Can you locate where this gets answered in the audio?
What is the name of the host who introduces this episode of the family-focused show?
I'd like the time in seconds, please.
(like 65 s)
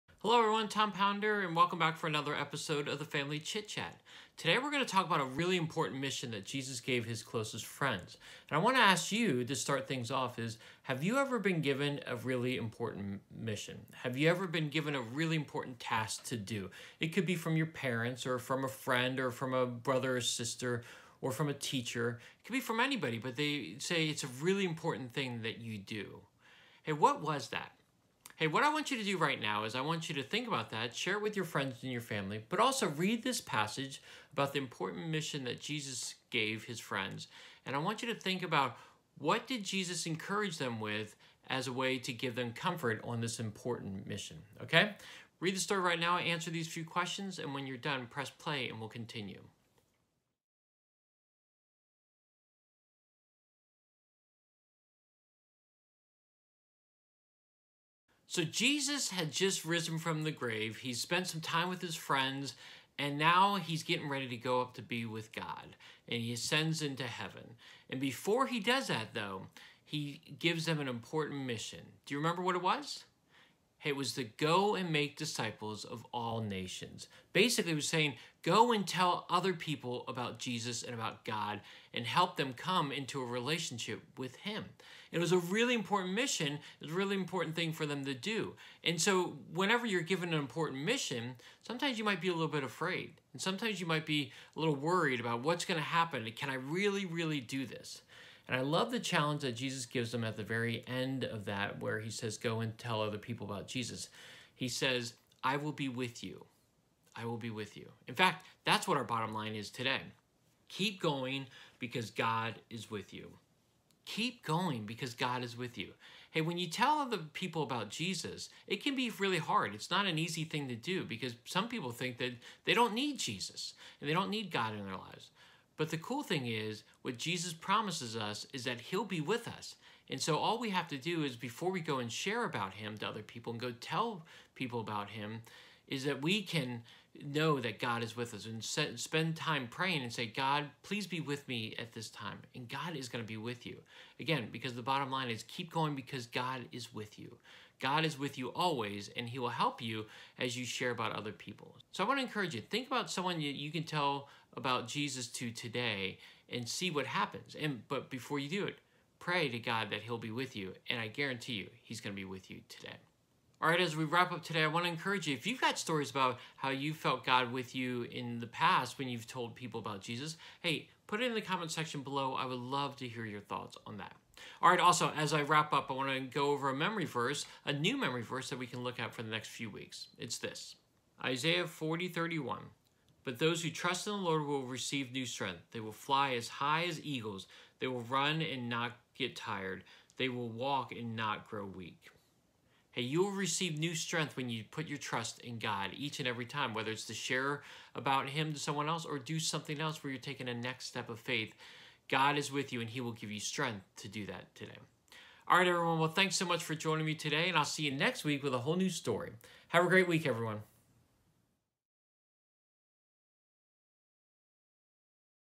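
0 s.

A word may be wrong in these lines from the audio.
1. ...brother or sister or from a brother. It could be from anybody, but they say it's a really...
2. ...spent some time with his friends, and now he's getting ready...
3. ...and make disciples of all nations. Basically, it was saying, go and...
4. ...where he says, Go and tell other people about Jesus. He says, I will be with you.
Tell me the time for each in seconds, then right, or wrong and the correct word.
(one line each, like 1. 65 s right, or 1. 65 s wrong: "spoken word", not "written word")
1. 19 s wrong: "teacher", not "brother"
2. 60 s right
3. 74 s right
4. 101 s right.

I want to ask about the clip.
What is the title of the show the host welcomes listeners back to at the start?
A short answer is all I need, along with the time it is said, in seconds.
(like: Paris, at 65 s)
Family Chit Chat, at 3 s.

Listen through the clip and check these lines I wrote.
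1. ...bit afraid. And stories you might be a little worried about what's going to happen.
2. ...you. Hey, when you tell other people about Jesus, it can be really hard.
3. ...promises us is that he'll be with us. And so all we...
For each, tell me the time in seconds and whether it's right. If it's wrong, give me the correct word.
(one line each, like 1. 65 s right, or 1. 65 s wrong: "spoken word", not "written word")
1. 92 s wrong: "sometimes", not "stories"
2. 115 s right
3. 127 s right.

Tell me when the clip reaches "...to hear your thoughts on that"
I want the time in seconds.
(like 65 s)
172 s.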